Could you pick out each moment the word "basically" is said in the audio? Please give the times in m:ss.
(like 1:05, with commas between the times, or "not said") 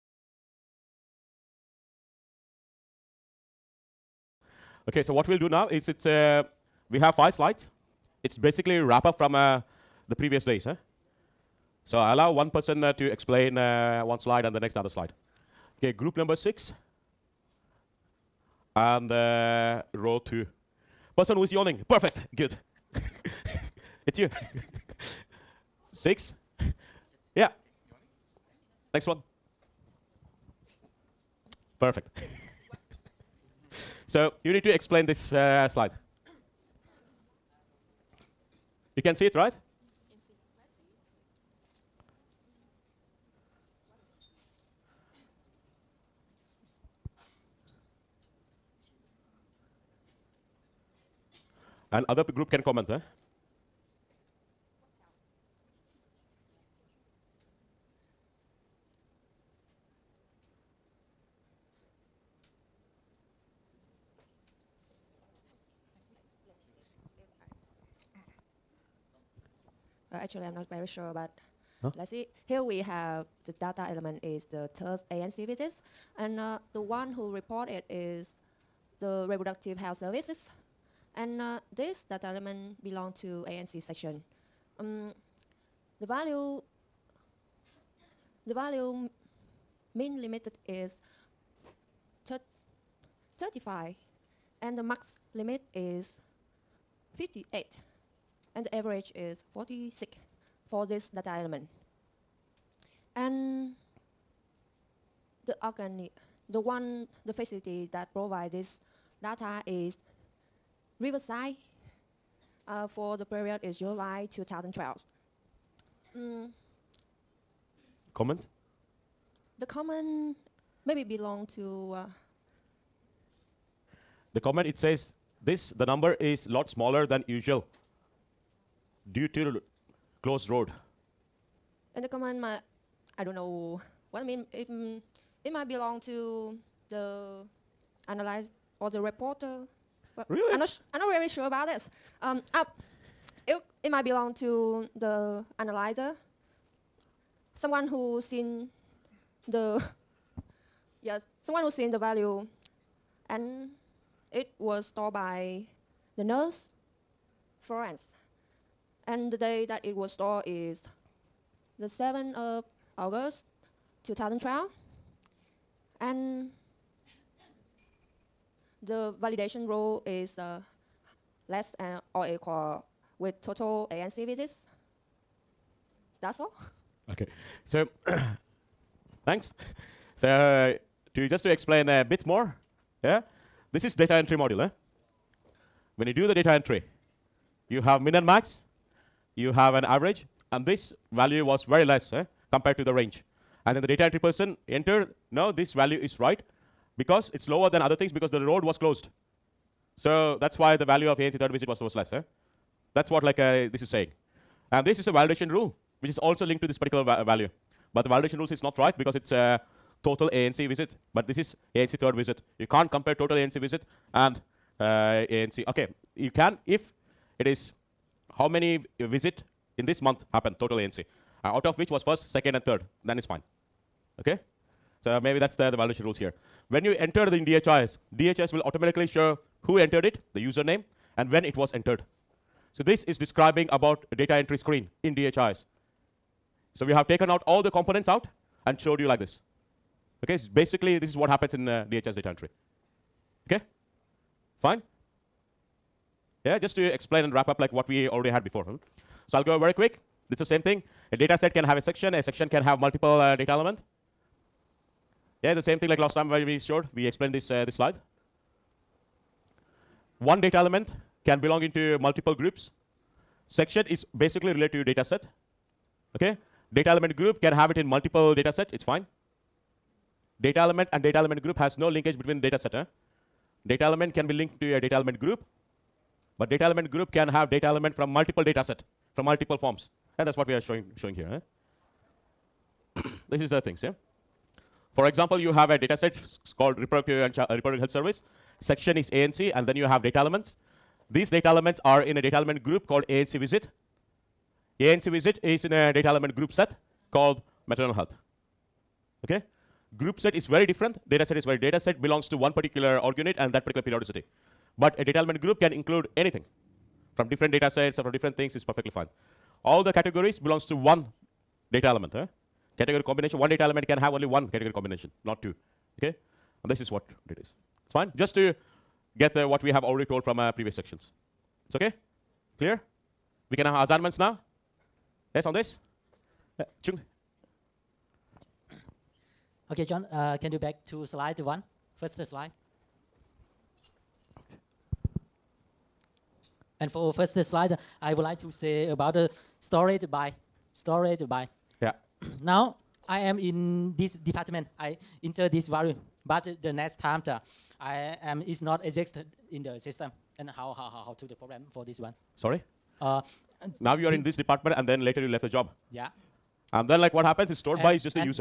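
0:08, 4:00, 4:24.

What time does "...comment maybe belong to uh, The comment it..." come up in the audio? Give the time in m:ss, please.
1:59.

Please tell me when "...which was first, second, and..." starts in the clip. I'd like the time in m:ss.
3:41.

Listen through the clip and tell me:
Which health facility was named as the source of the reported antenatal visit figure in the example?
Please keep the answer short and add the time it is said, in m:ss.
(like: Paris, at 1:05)
Riverside, at 1:50.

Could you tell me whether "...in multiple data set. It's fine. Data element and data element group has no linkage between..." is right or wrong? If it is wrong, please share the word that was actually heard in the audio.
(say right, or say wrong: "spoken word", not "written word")
right.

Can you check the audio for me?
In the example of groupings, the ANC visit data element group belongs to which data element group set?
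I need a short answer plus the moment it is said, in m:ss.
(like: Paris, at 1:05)
maternal health, at 4:57.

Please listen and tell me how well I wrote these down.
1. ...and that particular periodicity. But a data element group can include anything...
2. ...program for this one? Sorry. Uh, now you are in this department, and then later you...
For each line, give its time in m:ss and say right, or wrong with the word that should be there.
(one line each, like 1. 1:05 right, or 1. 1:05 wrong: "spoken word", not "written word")
1. 5:03 right
2. 5:51 right.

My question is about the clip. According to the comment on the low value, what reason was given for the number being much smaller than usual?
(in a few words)
closed road.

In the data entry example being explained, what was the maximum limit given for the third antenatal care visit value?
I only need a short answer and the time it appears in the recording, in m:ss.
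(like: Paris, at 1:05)
58, at 1:37.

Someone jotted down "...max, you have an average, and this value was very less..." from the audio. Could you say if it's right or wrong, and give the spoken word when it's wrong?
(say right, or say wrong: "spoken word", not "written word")
right.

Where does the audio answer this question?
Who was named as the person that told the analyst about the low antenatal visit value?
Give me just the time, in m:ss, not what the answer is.
2:37.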